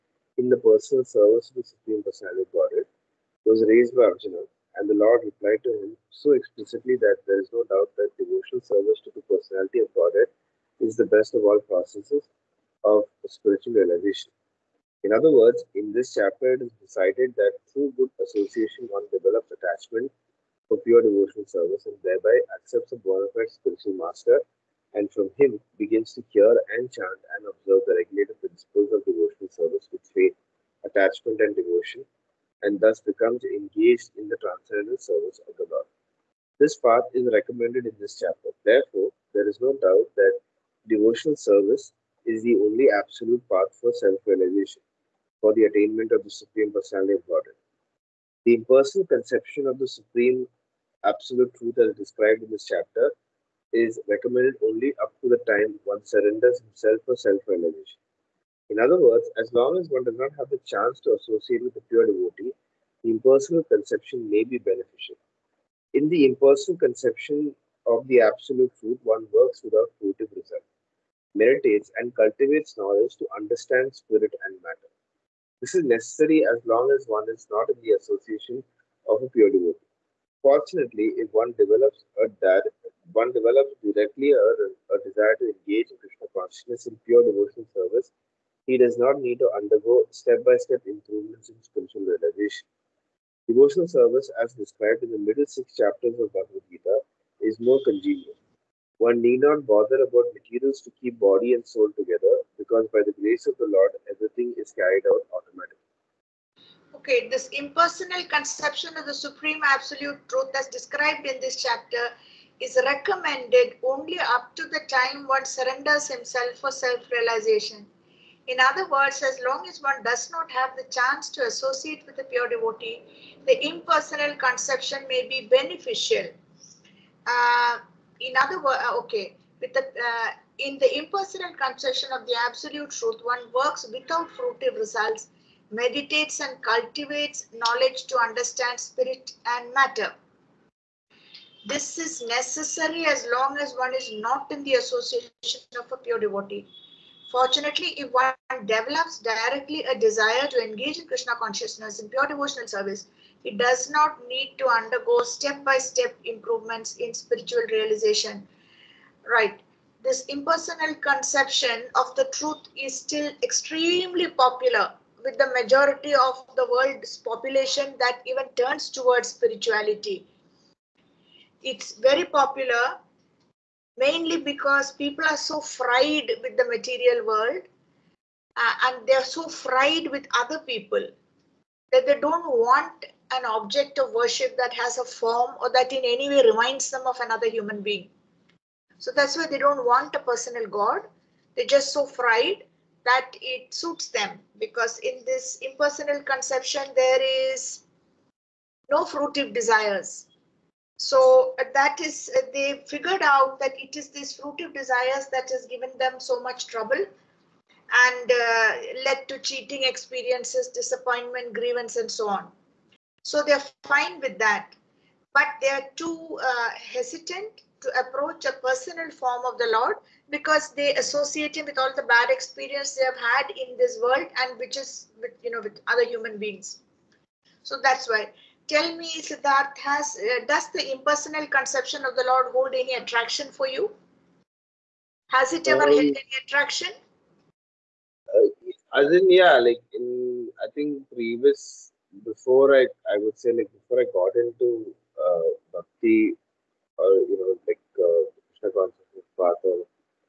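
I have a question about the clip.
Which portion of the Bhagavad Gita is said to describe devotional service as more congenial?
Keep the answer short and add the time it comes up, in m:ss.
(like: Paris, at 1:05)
Middle six chapters, at 1:35.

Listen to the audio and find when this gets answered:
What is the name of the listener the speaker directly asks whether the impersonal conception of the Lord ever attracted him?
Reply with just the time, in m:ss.
3:49.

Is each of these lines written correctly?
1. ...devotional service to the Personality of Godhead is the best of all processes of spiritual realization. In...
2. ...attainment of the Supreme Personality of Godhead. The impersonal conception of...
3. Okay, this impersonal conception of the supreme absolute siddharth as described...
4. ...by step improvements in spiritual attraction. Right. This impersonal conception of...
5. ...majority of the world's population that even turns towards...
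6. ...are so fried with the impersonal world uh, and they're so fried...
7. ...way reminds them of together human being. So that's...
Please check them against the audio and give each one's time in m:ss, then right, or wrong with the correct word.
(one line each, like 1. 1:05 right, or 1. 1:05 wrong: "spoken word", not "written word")
1. 0:08 right
2. 0:45 right
3. 1:46 wrong: "truth", not "siddharth"
4. 2:35 wrong: "realization", not "attraction"
5. 2:45 right
6. 2:55 wrong: "material", not "impersonal"
7. 3:06 wrong: "another", not "together".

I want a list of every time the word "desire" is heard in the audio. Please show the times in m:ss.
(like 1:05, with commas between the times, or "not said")
1:25, 2:29, 3:19, 3:24.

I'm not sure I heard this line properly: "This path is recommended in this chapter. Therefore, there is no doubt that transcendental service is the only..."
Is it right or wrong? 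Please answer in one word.
wrong.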